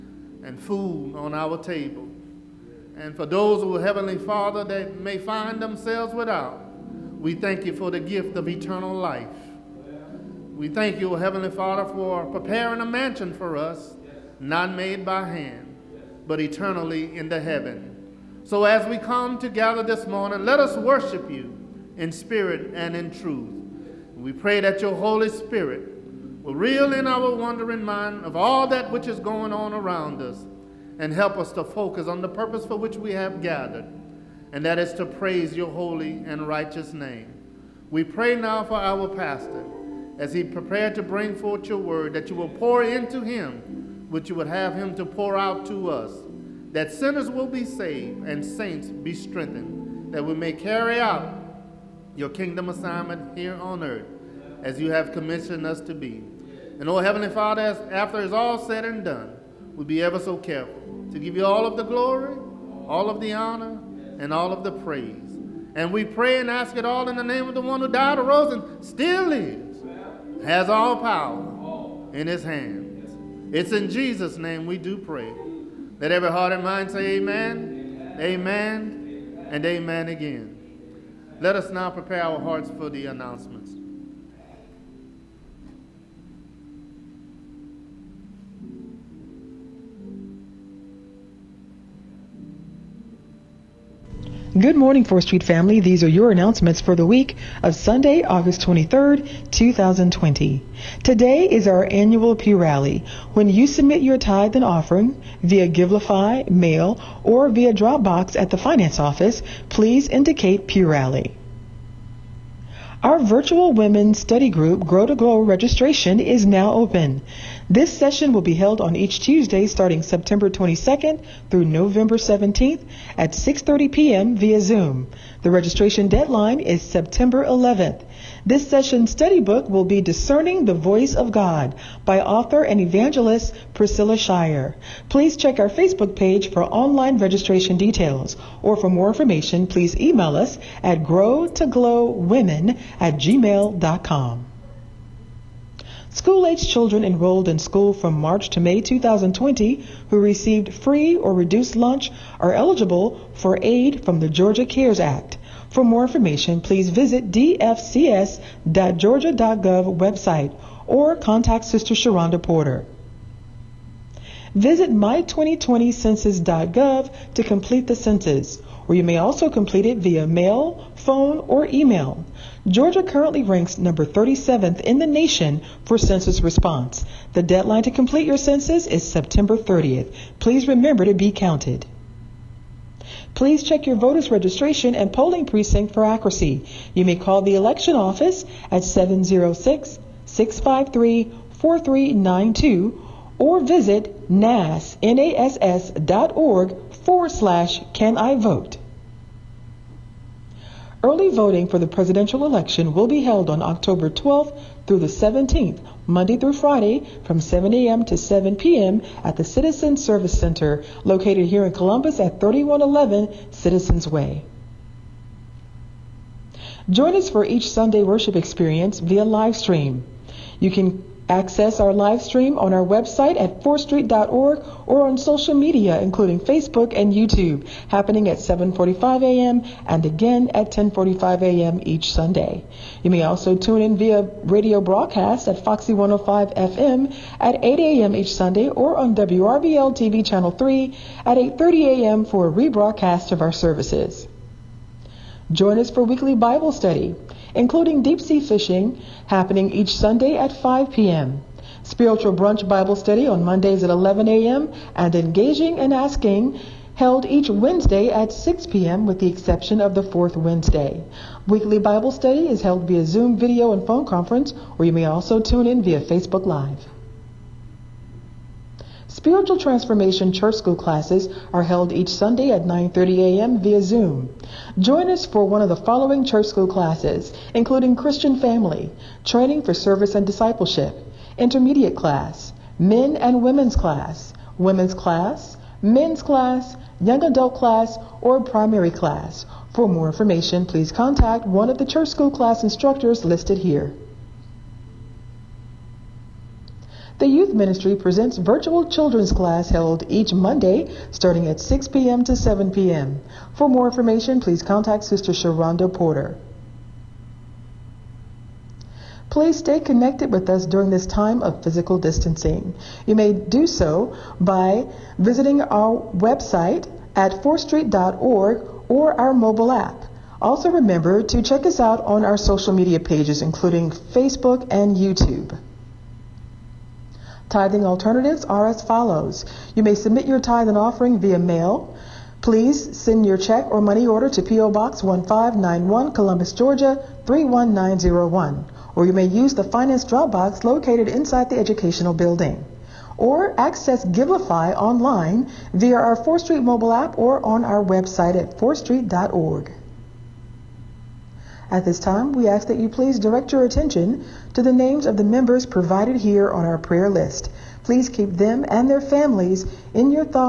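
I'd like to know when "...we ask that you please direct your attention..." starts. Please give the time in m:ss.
5:52.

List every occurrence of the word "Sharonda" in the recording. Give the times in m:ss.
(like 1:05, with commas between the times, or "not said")
2:41, 5:05.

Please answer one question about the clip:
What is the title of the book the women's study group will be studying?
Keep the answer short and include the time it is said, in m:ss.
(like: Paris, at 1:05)
Discerning the Voice of God, at 2:10.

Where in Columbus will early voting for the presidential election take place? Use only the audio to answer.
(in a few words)
Citizen Service Center.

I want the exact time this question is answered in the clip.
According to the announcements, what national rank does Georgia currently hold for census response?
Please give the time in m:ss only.
2:53.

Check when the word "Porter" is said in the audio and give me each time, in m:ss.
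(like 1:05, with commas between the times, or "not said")
2:42, 5:05.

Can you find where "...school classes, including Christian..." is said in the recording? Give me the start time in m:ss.
4:36.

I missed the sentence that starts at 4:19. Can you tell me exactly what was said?
with the exception of the fourth Wednesday.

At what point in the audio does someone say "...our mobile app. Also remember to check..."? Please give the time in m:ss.
5:19.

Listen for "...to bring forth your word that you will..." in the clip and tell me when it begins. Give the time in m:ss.
0:40.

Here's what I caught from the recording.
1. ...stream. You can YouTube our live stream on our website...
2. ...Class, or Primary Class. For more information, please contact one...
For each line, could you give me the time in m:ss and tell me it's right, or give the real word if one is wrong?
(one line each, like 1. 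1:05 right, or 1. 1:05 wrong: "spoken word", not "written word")
1. 3:39 wrong: "Access", not "YouTube"
2. 4:47 right.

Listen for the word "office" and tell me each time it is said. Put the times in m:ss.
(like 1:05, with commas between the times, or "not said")
1:48, 3:07.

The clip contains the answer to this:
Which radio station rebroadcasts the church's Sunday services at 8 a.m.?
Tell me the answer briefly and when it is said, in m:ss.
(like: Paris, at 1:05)
Foxy 105 FM, at 3:55.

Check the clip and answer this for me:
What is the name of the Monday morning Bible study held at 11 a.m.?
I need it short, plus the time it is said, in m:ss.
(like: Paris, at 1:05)
Spiritual Brunch, at 4:11.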